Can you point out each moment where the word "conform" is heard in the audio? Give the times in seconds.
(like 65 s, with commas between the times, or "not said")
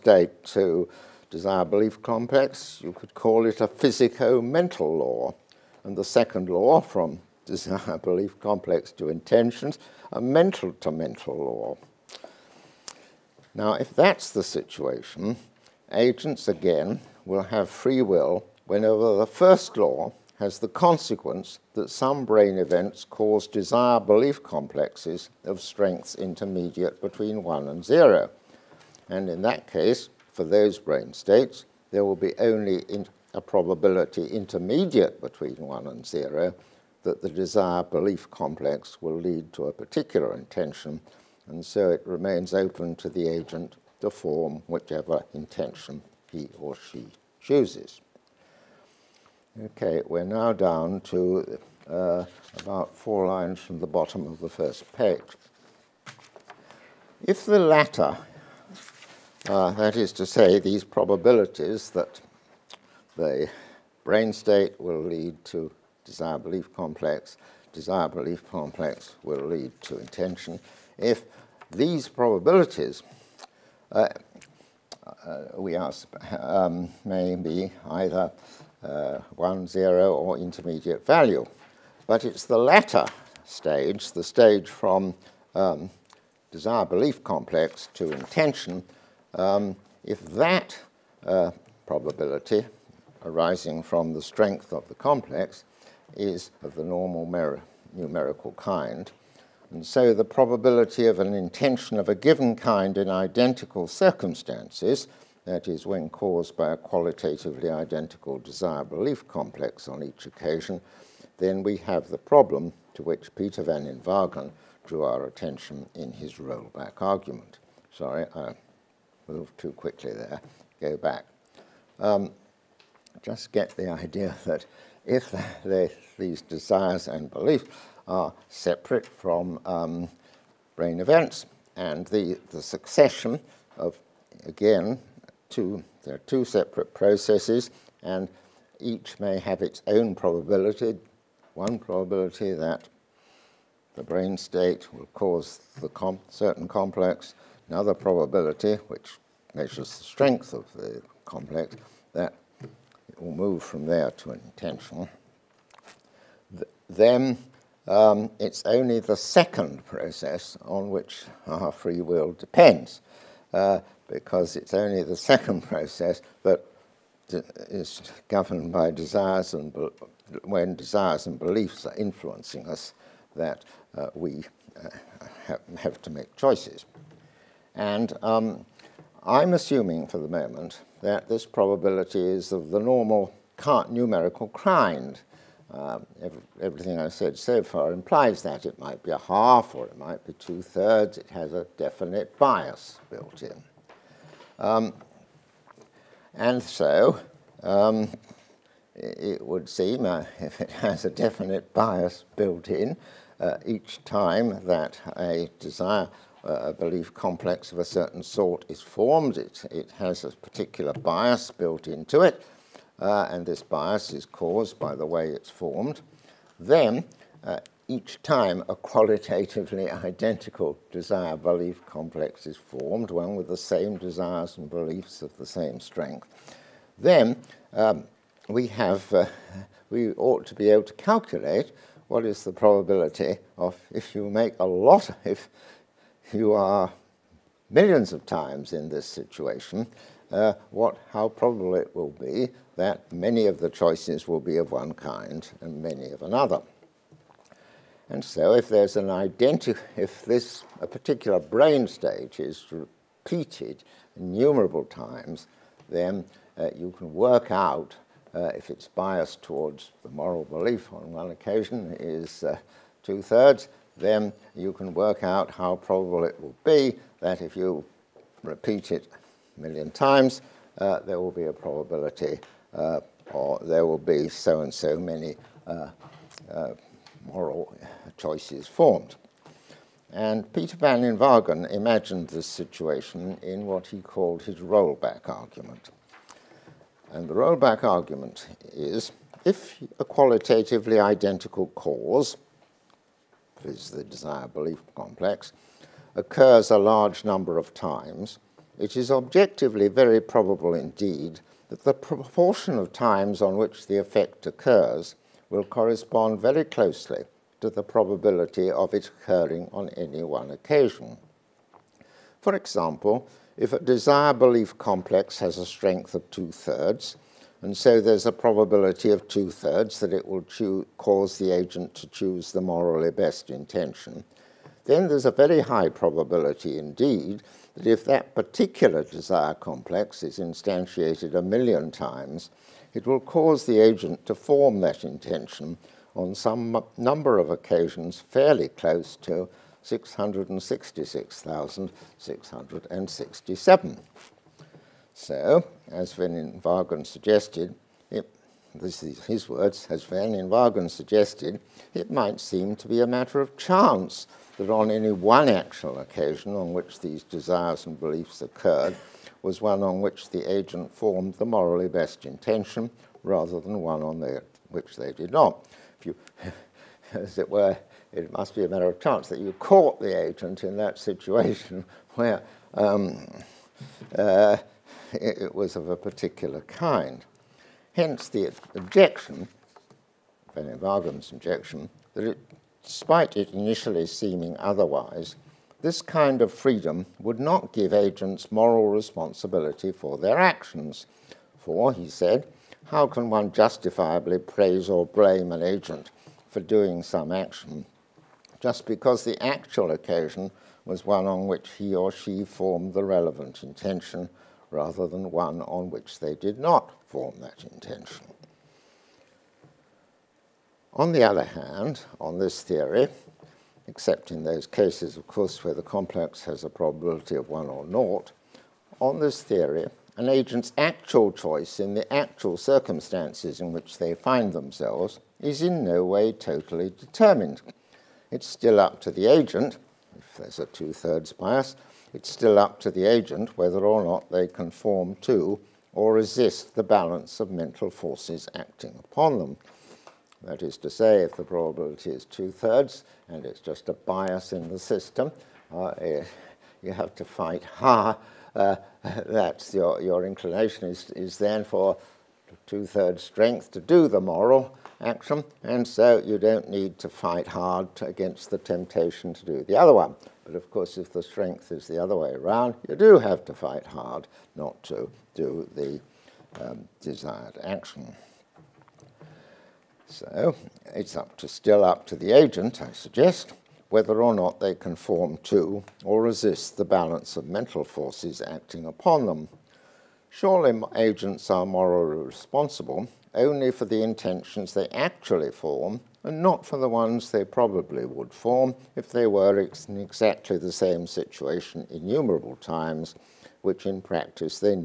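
434 s, 474 s.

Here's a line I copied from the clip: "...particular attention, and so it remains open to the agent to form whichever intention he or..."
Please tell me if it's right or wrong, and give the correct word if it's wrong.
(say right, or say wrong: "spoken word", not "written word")
wrong: "intention", not "attention".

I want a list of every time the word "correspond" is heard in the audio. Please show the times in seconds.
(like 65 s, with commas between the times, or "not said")
305 s.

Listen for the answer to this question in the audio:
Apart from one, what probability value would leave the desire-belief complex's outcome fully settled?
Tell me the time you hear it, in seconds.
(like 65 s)
417 s.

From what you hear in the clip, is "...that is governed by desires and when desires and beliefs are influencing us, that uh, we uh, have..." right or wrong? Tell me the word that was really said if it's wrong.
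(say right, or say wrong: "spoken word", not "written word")
right.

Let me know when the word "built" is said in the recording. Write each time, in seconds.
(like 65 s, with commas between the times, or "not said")
193 s, 202 s, 211 s.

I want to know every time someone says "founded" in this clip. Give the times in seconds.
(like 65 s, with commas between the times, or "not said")
not said.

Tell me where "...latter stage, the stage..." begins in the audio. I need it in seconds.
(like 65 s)
82 s.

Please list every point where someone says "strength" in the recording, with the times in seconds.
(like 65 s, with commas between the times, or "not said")
25 s, 94 s, 150 s, 225 s, 315 s, 453 s, 461 s.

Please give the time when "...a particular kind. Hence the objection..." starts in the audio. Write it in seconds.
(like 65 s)
375 s.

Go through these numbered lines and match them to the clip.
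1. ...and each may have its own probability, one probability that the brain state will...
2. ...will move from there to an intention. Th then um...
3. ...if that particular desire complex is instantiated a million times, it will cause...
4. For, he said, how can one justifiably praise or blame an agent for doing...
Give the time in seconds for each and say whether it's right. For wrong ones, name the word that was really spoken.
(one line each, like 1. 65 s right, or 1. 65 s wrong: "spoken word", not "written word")
1. 138 s right
2. 153 s right
3. 327 s right
4. 391 s right.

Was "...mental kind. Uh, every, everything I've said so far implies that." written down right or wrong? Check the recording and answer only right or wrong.
wrong.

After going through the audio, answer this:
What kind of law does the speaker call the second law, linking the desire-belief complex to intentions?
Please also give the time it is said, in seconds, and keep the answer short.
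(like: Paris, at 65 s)
mental to mental law, at 10 s.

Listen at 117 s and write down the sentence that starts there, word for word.
Sorry, I moved too quickly there, go back.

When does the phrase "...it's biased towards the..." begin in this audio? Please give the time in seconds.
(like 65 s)
258 s.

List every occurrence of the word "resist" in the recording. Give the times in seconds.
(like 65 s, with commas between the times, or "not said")
436 s, 476 s.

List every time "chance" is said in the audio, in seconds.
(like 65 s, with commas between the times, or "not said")
353 s, 369 s.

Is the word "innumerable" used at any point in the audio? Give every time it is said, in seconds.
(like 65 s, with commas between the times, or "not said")
254 s, 491 s.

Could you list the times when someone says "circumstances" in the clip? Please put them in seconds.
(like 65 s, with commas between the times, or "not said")
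103 s, 422 s.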